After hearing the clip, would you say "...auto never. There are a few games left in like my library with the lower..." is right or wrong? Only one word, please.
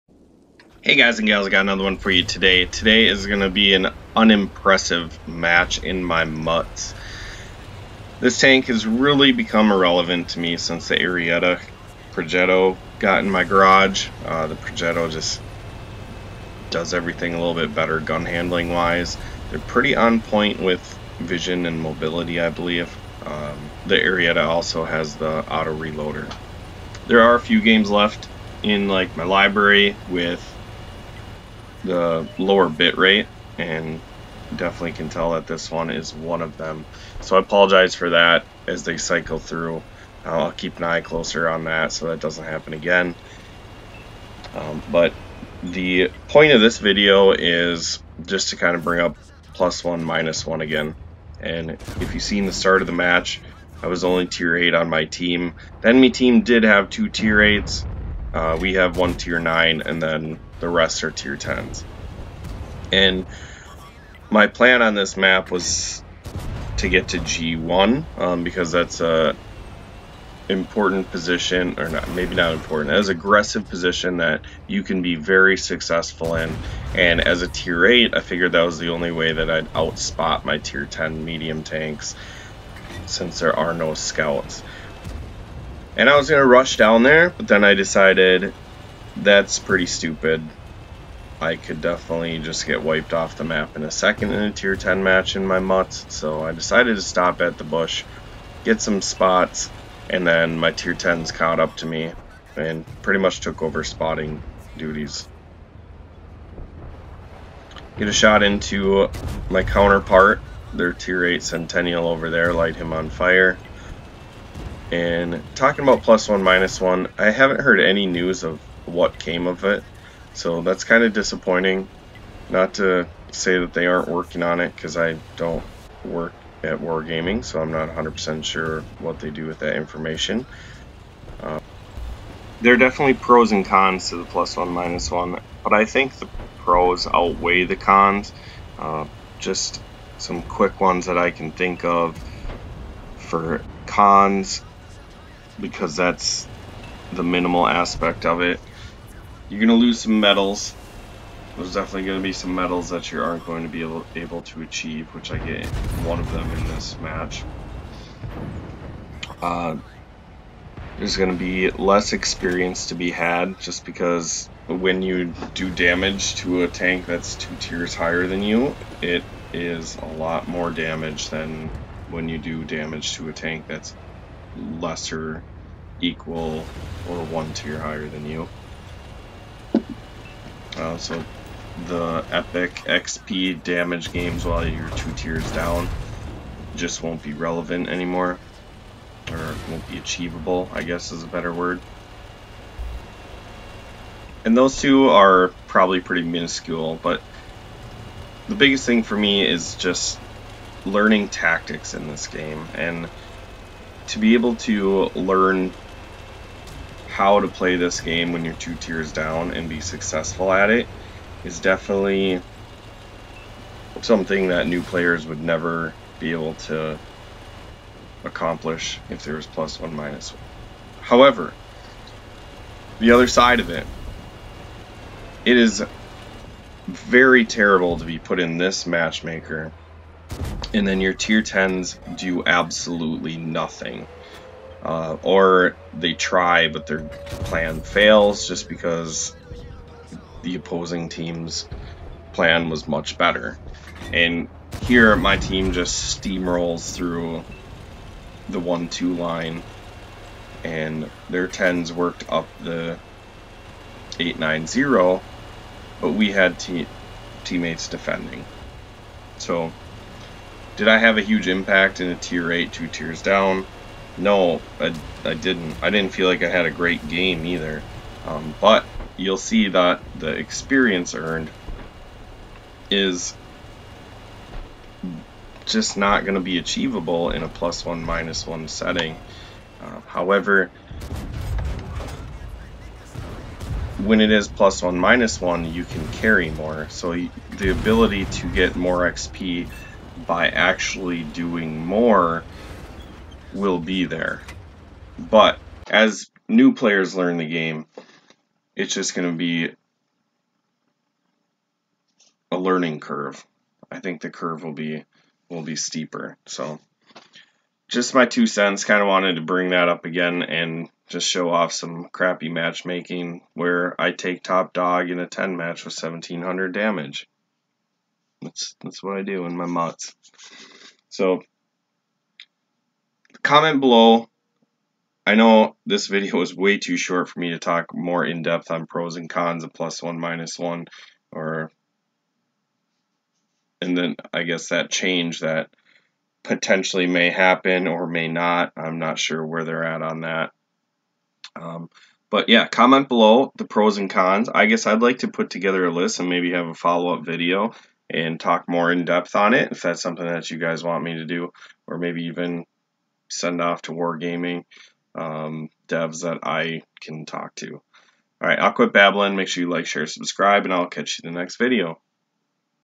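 wrong.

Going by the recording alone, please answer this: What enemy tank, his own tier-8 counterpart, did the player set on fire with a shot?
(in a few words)
Centennial.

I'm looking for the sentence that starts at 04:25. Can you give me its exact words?
I didn't feel like I had a great game either.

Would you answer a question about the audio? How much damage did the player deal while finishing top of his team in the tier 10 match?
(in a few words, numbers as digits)
1700.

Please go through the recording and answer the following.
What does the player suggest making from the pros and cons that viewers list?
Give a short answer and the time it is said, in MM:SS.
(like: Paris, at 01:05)
follow up video, at 05:46.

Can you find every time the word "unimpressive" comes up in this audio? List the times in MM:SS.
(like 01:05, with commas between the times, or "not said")
00:04.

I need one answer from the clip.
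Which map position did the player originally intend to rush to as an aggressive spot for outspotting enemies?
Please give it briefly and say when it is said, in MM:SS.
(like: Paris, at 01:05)
G1, at 01:07.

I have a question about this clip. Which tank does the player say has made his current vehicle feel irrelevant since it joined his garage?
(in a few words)
Arietta Progetto.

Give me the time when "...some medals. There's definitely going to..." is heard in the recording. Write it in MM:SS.
02:29.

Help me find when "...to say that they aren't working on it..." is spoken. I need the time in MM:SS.
02:02.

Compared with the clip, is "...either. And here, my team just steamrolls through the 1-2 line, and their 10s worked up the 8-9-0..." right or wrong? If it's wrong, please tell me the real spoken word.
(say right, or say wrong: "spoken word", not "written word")
wrong: "better", not "either".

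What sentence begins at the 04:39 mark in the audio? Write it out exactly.
Uh, however, when it is plus one minus one, you can carry more.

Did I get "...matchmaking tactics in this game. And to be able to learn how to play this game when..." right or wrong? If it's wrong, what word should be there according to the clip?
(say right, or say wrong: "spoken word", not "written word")
wrong: "learning", not "matchmaking".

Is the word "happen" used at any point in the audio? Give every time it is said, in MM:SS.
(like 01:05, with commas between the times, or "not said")
00:42, 05:37.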